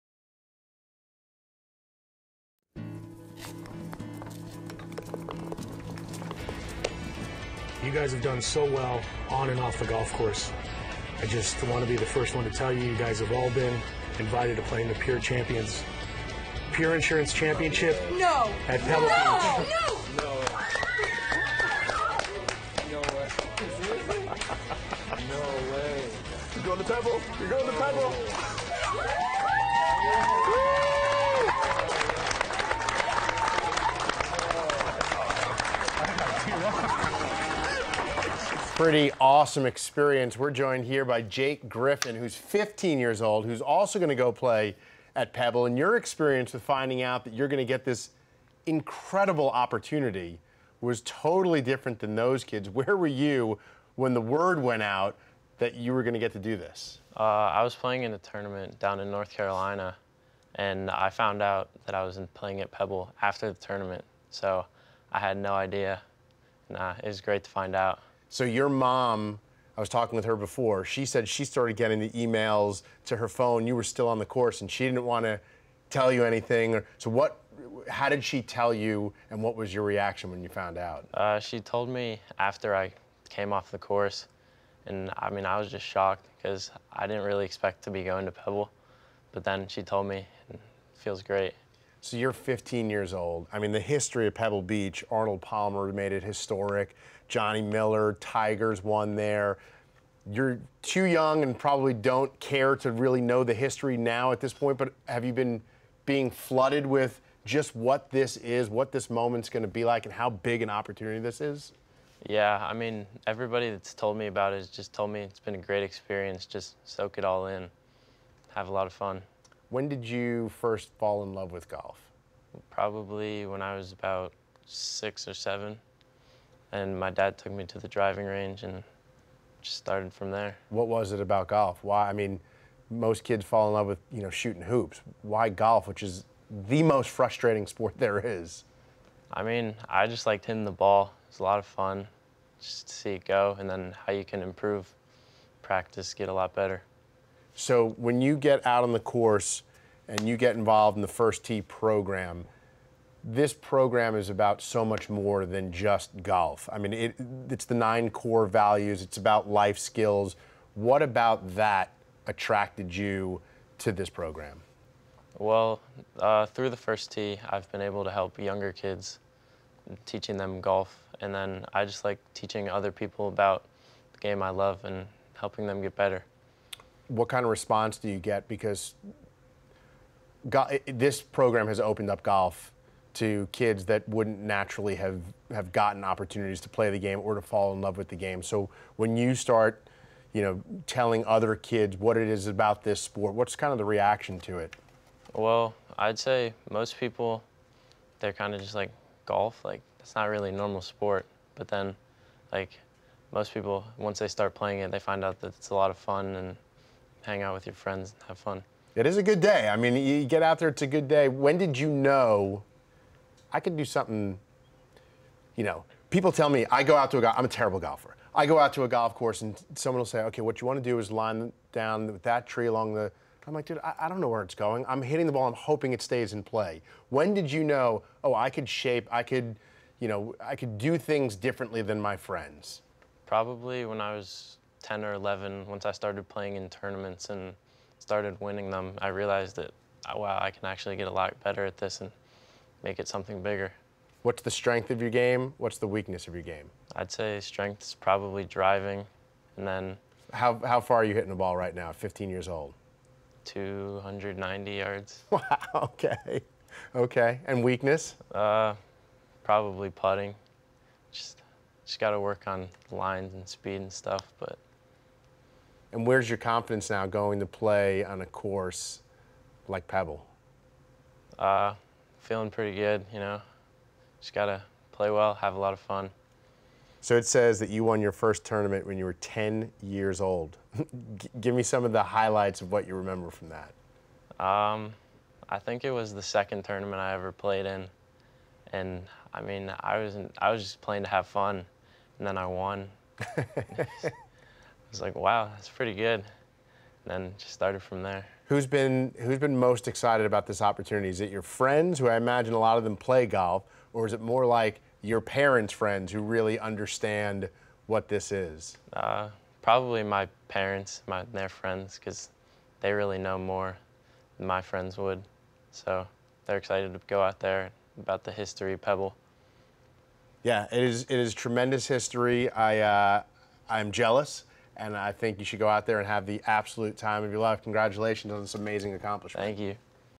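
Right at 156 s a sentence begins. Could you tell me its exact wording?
I mean, it, it's the nine core values, it's about life skills.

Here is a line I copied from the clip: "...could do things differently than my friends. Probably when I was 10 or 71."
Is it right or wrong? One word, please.
wrong.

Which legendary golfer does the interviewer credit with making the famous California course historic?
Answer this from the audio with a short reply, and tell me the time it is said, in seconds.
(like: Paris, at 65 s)
Arnold Palmer, at 95 s.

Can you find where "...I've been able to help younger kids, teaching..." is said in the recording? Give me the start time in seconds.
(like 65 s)
167 s.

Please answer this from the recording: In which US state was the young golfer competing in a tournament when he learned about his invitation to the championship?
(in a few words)
North Carolina.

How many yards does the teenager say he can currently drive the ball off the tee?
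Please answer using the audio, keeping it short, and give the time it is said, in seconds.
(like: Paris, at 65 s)
290 yards, at 253 s.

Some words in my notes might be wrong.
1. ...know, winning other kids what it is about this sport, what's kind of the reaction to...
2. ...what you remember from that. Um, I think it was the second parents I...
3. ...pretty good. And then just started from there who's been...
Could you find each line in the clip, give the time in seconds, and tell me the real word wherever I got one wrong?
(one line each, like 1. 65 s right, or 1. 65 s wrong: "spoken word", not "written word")
1. 190 s wrong: "telling", not "winning"
2. 282 s wrong: "tournament", not "parents"
3. 295 s right.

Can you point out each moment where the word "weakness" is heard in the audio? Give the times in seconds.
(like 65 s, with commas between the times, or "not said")
245 s, 257 s.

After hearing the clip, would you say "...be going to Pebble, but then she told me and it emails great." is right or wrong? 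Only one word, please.
wrong.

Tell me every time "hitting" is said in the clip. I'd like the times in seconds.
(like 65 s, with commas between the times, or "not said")
140 s, 225 s, 251 s.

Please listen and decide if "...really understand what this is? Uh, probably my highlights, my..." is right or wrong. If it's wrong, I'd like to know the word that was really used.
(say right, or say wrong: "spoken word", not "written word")
wrong: "parents", not "highlights".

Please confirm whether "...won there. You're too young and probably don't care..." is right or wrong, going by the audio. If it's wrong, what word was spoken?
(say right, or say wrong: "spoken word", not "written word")
right.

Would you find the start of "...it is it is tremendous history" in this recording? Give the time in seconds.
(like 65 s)
320 s.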